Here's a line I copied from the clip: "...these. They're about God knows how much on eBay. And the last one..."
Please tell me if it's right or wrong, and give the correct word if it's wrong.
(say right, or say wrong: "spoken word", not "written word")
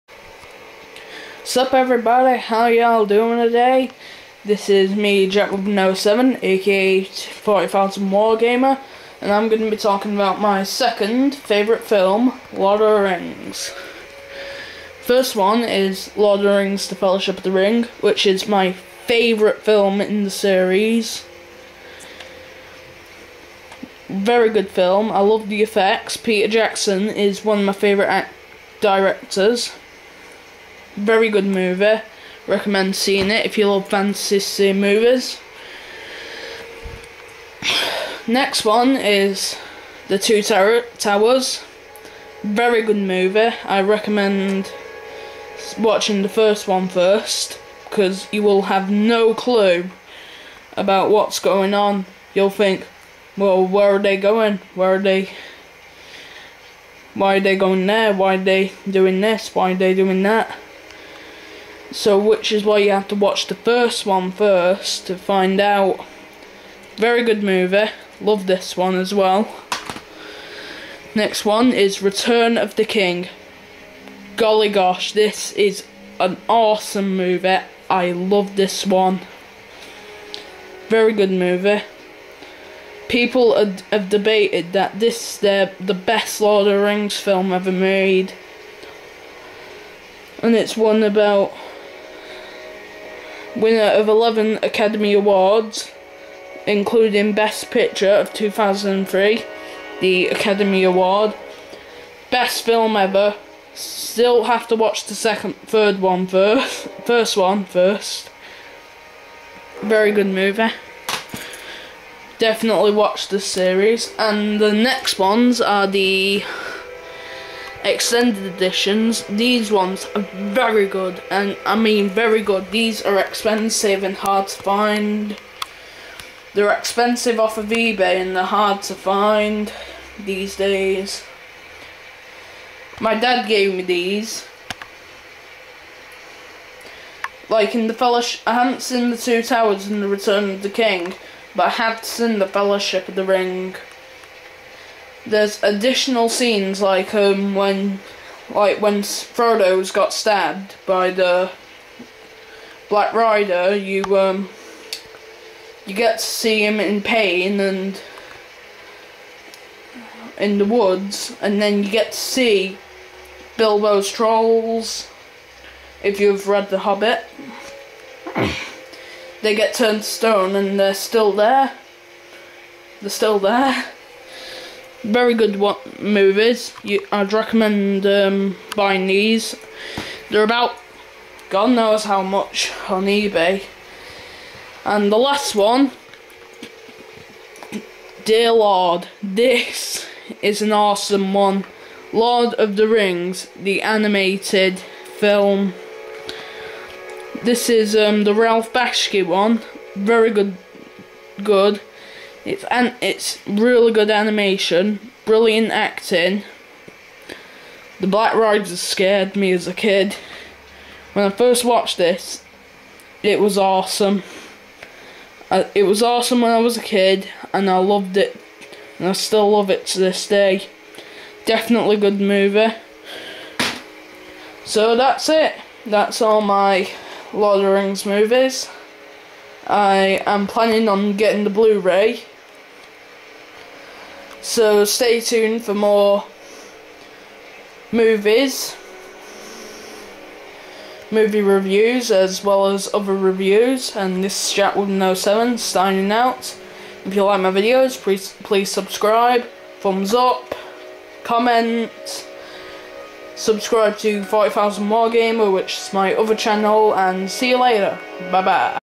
right.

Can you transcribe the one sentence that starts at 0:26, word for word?
Peter Jackson is one of my favourite directors very good movie.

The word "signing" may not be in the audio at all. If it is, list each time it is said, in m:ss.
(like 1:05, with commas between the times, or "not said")
4:05.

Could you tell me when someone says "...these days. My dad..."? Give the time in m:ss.
2:10.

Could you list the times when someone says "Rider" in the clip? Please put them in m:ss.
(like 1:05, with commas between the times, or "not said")
2:33, 3:28.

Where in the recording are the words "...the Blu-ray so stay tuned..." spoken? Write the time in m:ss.
3:51.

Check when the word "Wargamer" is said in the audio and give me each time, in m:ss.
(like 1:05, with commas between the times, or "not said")
0:08, 4:14.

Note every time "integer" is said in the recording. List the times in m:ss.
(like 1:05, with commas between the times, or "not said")
not said.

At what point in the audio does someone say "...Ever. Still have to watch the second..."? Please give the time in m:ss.
1:42.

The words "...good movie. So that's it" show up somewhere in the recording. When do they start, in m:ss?
3:41.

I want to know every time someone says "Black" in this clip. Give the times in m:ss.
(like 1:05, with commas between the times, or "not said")
2:32, 3:28.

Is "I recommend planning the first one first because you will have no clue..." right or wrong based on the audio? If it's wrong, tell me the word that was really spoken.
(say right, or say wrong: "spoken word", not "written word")
wrong: "watching", not "planning".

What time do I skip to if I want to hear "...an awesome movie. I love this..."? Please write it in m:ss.
1:16.